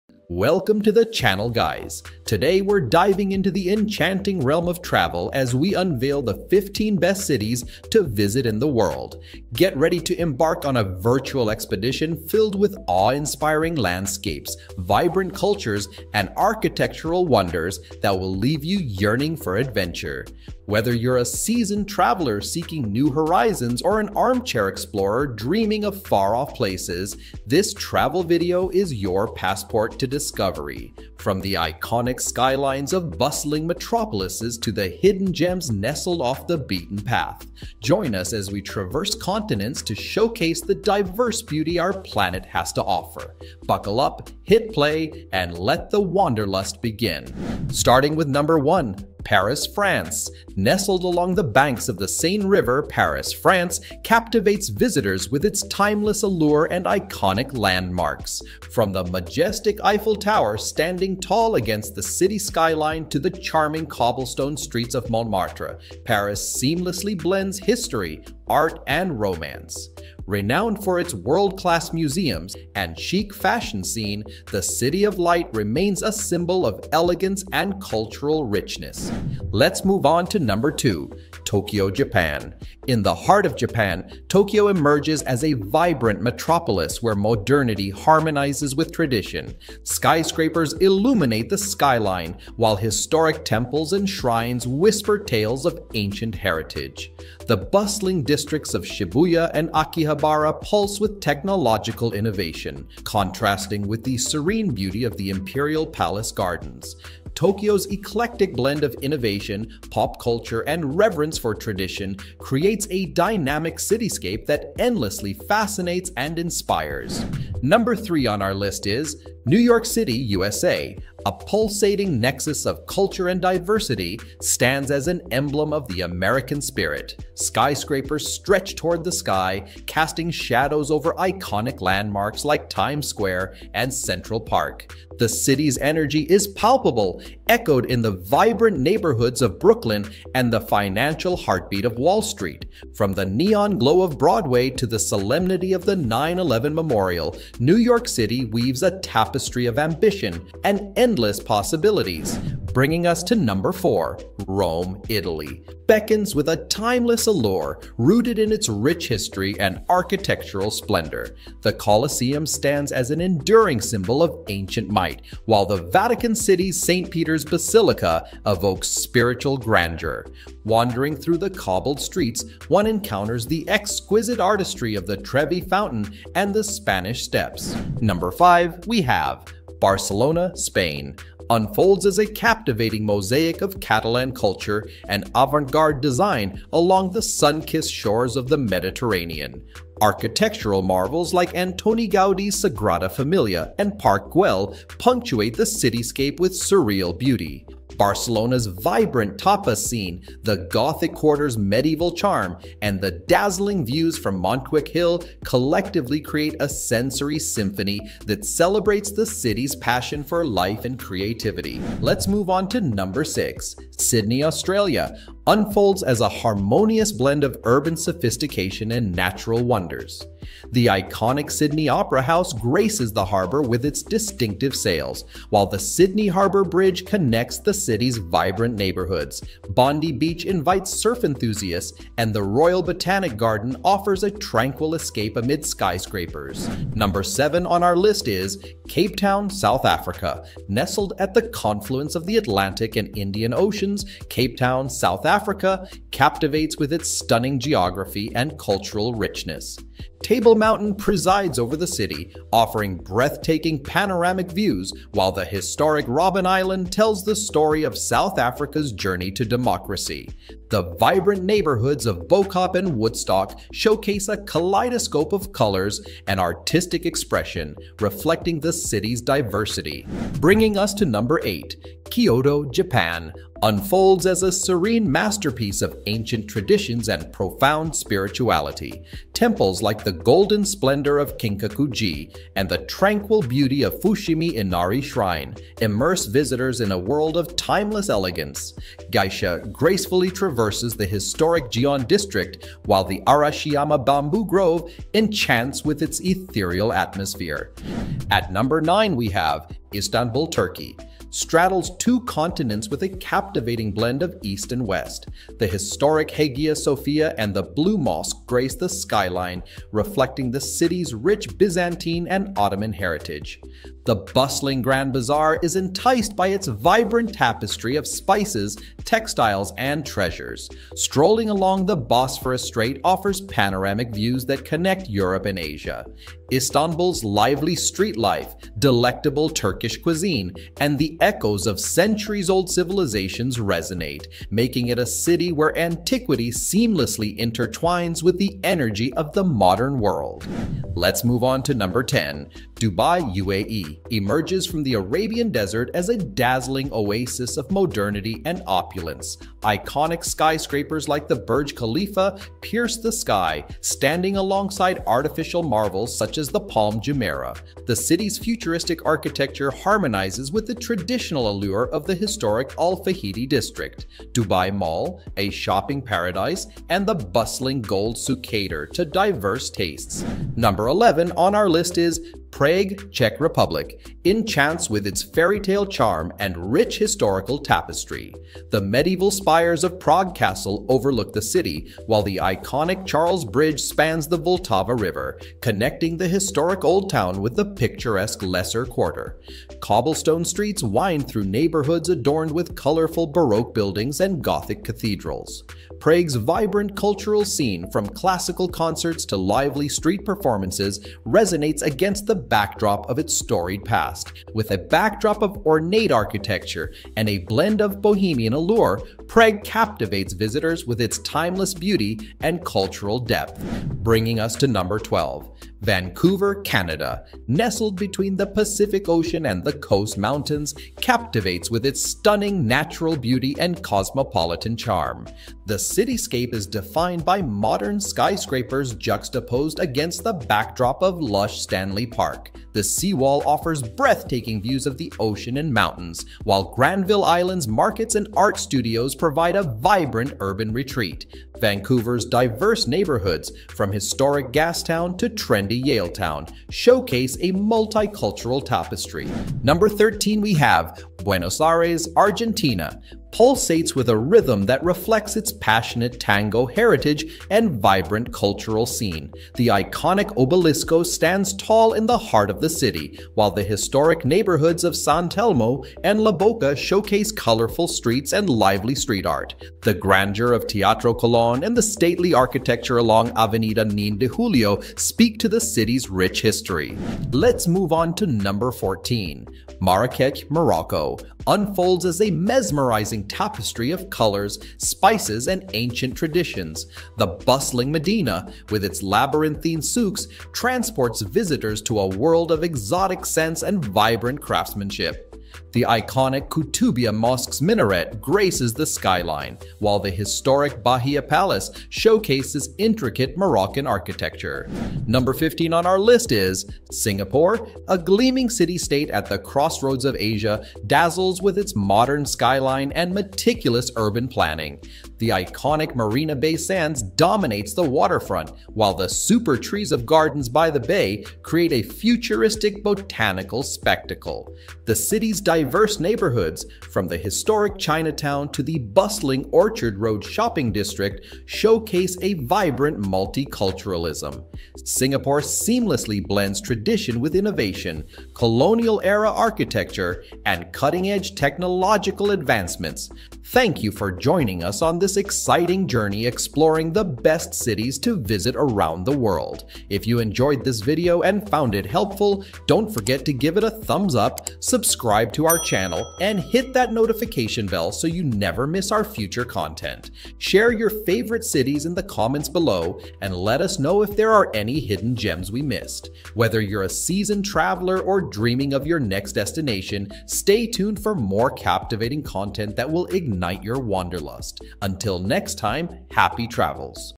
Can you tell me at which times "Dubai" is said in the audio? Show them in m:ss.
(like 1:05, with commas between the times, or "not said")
5:42, 6:04.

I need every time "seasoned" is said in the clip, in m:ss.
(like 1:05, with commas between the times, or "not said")
0:21, 9:26.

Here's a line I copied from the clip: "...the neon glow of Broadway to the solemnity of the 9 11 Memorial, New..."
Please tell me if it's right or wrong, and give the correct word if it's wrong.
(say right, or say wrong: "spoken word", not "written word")
right.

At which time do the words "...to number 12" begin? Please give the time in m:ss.
6:54.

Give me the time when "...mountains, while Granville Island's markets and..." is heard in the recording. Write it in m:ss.
7:15.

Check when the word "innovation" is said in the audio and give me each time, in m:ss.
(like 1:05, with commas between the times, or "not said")
1:42, 1:48, 8:57.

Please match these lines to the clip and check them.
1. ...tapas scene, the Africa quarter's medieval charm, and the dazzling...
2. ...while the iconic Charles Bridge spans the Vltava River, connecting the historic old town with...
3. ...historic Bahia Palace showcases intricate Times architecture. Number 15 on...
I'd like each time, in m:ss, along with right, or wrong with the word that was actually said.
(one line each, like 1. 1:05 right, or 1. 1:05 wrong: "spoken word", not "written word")
1. 3:19 wrong: "Gothic", not "Africa"
2. 6:22 right
3. 8:20 wrong: "Moroccan", not "Times".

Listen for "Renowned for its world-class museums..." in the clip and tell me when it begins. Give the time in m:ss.
1:10.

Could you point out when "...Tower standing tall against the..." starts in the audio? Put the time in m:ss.
1:00.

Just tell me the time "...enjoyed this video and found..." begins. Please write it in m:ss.
9:10.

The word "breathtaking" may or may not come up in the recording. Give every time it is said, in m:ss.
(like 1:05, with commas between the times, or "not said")
4:12, 7:13.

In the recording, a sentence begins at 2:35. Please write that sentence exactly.
Beckons with a timeless allure rooted in its rich history and architectural splendor.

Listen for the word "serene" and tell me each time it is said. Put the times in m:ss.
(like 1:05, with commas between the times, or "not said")
1:44, 4:34.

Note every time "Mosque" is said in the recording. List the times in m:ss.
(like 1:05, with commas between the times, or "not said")
5:07, 8:17.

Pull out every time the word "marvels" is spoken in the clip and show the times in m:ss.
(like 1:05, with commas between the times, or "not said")
3:10, 5:55.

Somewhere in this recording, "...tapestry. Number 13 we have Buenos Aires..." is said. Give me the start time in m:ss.
7:28.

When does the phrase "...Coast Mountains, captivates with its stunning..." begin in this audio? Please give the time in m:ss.
6:59.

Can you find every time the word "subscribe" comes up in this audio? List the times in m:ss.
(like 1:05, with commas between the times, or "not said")
9:14.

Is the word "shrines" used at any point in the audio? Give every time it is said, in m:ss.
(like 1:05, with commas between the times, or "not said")
1:34, 4:44.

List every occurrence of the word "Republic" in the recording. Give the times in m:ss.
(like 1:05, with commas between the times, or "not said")
6:13.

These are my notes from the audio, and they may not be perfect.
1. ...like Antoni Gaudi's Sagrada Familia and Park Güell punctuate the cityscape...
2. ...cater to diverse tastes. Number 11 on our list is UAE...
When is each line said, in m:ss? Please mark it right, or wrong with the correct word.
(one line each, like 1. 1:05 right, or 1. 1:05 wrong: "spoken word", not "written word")
1. 3:11 right
2. 6:08 wrong: "Prague", not "UAE".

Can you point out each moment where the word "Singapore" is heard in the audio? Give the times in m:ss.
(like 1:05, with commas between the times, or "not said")
8:26, 8:54.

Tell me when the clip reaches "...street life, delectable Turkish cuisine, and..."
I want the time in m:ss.
5:27.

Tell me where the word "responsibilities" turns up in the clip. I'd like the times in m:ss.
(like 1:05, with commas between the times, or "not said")
not said.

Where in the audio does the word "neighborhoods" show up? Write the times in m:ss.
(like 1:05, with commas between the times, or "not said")
2:18, 3:48, 4:21, 6:31, 7:22, 7:44, 8:45.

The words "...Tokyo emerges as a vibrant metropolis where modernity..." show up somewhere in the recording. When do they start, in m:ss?
1:24.